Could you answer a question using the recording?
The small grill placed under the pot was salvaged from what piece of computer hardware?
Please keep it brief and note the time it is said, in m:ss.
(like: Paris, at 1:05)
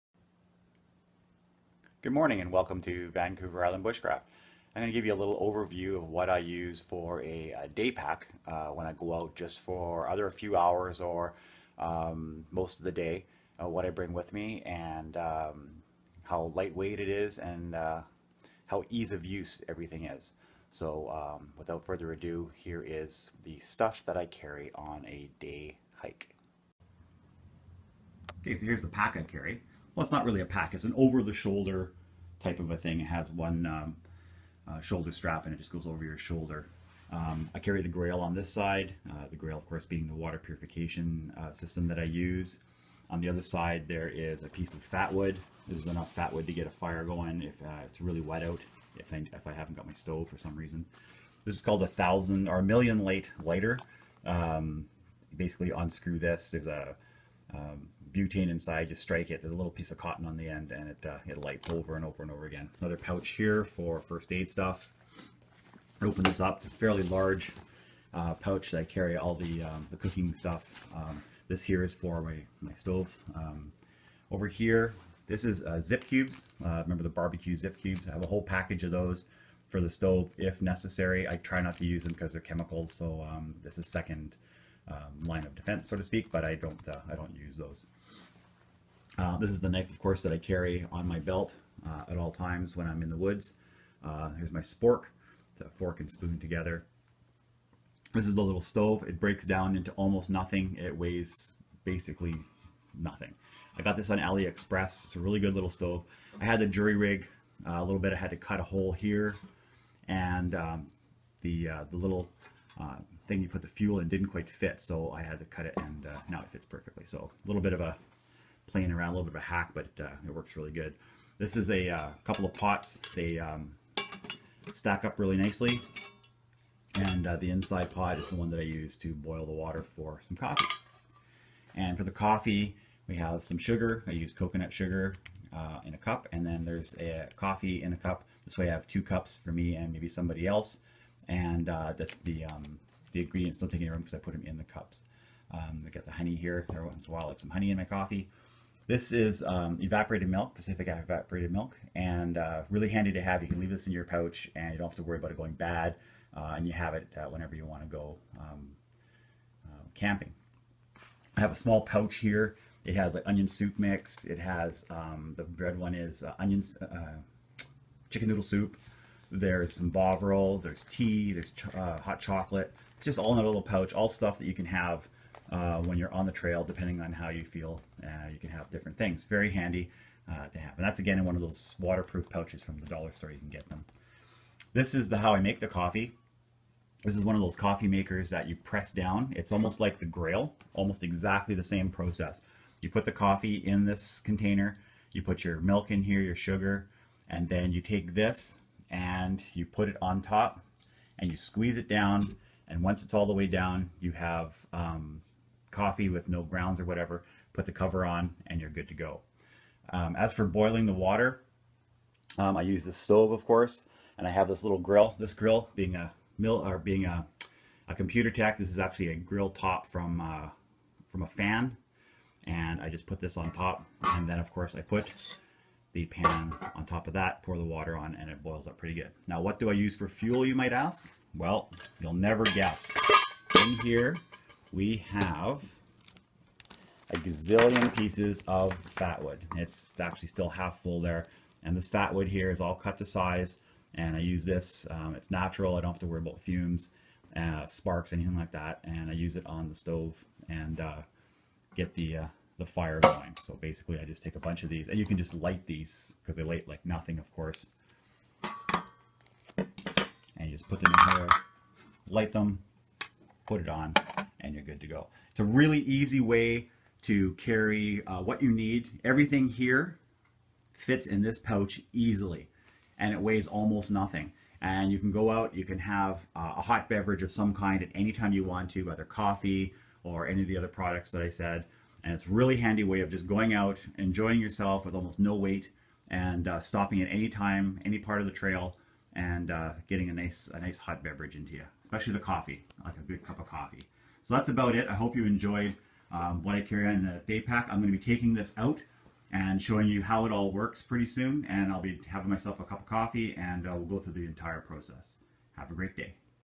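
a fan, at 3:39.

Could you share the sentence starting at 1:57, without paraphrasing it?
So a little bit of a playing around a little bit of a hack, but uh, it works really good.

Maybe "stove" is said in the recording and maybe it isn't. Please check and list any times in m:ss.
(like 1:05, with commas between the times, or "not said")
0:49, 1:12, 1:19, 1:38, 1:45, 3:32, 4:09.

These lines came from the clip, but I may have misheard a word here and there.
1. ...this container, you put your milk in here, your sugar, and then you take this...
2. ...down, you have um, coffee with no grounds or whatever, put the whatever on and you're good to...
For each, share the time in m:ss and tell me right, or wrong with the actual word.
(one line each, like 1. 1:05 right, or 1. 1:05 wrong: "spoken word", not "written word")
1. 3:13 right
2. 3:23 wrong: "cover", not "whatever".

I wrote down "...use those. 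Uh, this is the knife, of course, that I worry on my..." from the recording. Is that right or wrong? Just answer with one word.
wrong.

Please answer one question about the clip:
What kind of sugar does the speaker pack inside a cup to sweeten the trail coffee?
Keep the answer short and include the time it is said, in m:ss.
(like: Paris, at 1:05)
coconut sugar, at 2:14.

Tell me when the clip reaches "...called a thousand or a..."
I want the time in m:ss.
0:51.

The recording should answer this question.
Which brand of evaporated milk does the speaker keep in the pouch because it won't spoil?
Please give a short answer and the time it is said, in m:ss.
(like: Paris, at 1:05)
Pacific, at 2:30.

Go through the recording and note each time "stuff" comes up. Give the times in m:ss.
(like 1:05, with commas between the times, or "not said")
0:23, 1:04, 1:10, 2:54.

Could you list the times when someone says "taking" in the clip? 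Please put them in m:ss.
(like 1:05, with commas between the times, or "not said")
4:58.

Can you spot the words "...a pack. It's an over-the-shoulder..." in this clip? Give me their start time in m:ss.
0:30.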